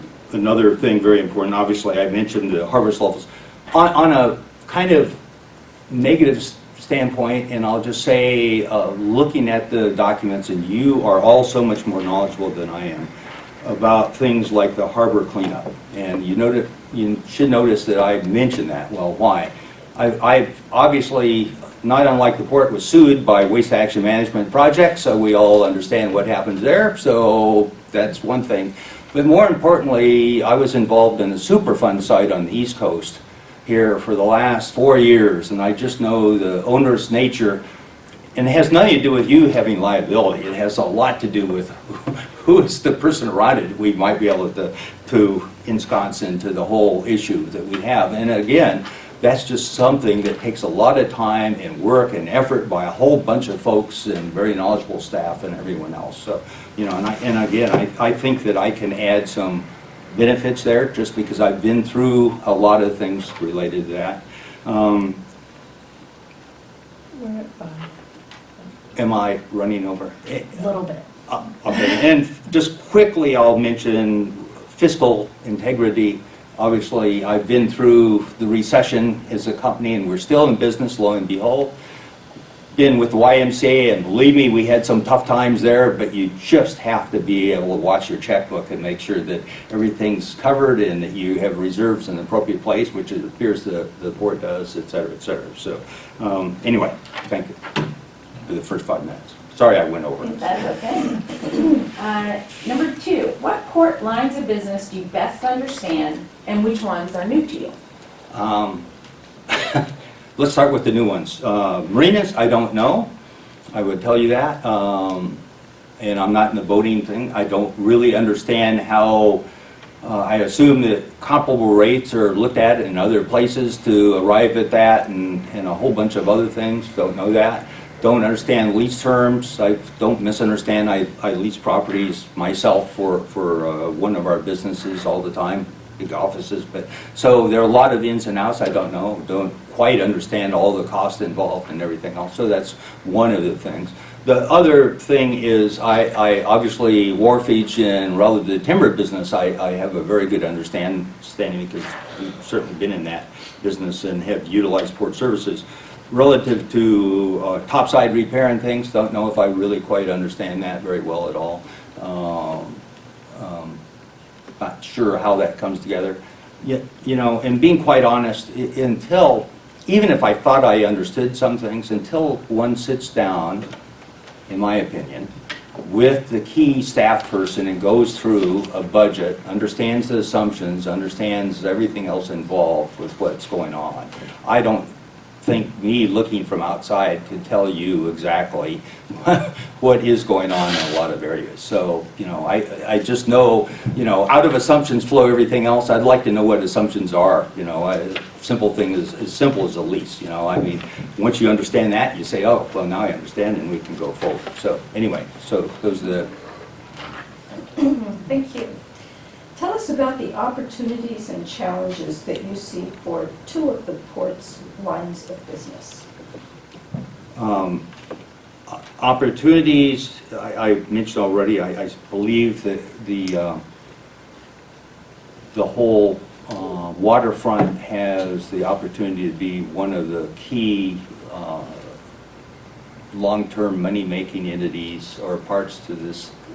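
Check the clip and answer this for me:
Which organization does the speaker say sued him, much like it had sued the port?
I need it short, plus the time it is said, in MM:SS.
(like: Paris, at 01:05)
Waste Action Management Project, at 00:23.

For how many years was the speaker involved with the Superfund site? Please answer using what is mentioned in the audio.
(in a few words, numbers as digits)
4.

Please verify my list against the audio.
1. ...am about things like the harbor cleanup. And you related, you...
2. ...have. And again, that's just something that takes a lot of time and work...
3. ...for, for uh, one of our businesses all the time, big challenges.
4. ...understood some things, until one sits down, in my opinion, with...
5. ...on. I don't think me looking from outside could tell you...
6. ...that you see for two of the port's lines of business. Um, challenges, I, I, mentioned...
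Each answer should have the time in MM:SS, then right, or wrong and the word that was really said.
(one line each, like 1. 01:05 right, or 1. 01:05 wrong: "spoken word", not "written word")
1. 00:12 wrong: "noted", not "related"
2. 00:47 right
3. 02:12 wrong: "offices", not "challenges"
4. 02:50 right
5. 03:03 right
6. 03:32 wrong: "opportunities", not "challenges".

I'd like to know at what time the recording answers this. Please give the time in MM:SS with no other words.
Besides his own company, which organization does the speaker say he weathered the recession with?
01:23.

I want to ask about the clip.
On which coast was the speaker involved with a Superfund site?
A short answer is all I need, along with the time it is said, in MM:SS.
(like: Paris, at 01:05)
East Coast, at 00:32.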